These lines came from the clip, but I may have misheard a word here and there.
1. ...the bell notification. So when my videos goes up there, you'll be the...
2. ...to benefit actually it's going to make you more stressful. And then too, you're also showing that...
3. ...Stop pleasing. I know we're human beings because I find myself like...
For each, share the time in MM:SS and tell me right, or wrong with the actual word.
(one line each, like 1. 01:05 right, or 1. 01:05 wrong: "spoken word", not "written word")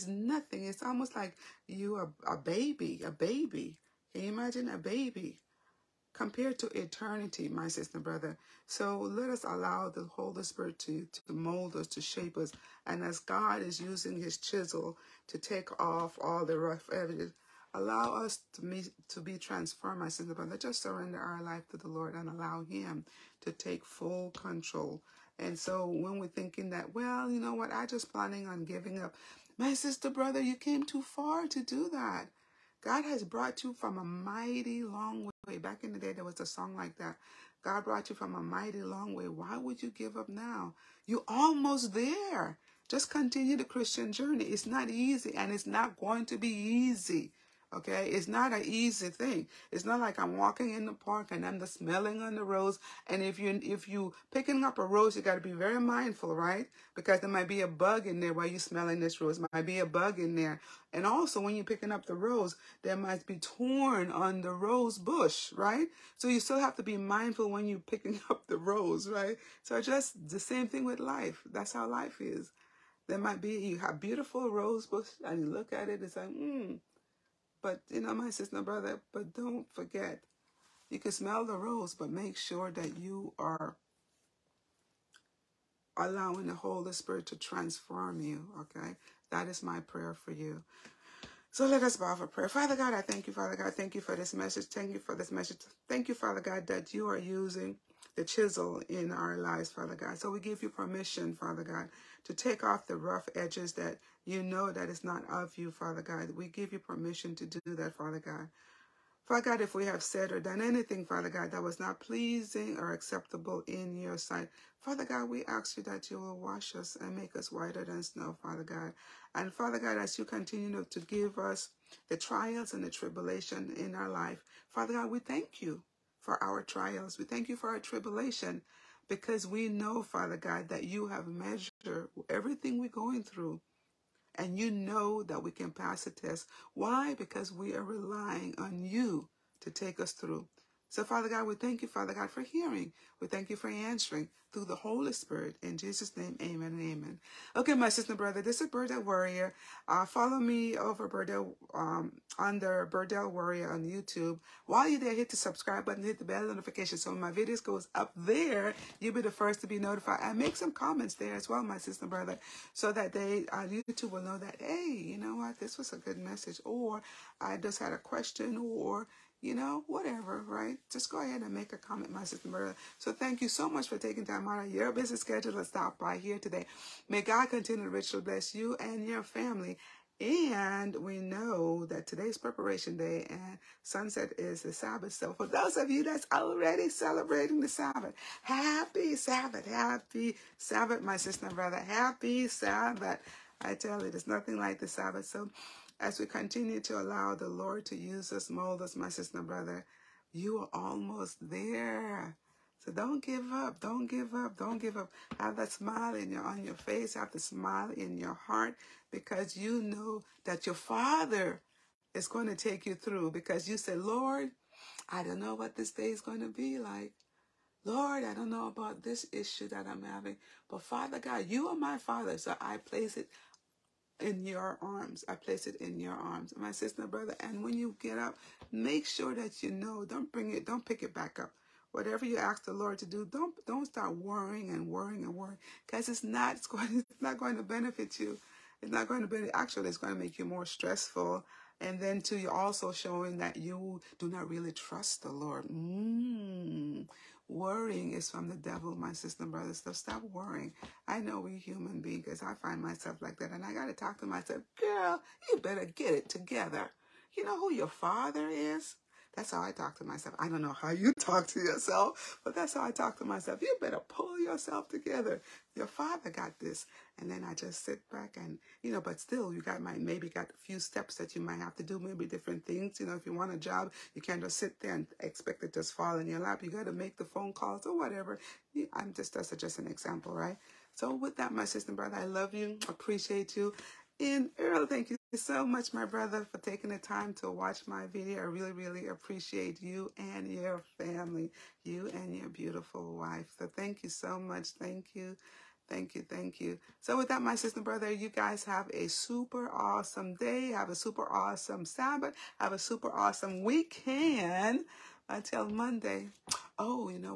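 1. 02:36 right
2. 03:59 right
3. 04:09 wrong: "worrying", not "pleasing".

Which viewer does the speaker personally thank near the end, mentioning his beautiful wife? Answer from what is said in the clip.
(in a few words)
Earl.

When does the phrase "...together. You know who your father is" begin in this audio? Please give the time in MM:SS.
04:16.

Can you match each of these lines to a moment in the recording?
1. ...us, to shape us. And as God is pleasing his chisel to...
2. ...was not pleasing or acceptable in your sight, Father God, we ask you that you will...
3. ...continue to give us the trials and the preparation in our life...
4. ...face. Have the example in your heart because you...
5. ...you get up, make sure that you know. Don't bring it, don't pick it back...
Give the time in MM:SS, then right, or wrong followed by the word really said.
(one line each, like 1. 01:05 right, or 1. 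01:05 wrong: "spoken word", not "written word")
1. 00:11 wrong: "using", not "pleasing"
2. 01:51 right
3. 02:00 wrong: "tribulation", not "preparation"
4. 03:26 wrong: "smile", not "example"
5. 03:47 right.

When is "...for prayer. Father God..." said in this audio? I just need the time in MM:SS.
01:32.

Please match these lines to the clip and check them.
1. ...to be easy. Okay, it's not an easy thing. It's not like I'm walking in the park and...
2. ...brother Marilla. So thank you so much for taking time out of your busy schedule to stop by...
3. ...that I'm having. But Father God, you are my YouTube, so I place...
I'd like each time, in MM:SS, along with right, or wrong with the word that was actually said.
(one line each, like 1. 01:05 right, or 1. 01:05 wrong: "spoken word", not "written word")
1. 00:46 right
2. 02:52 wrong: "sister", not "brother"
3. 03:39 wrong: "Father", not "YouTube".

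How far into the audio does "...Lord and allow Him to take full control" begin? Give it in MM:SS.
00:21.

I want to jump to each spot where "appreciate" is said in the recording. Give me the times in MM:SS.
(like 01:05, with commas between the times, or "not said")
04:42, 04:49.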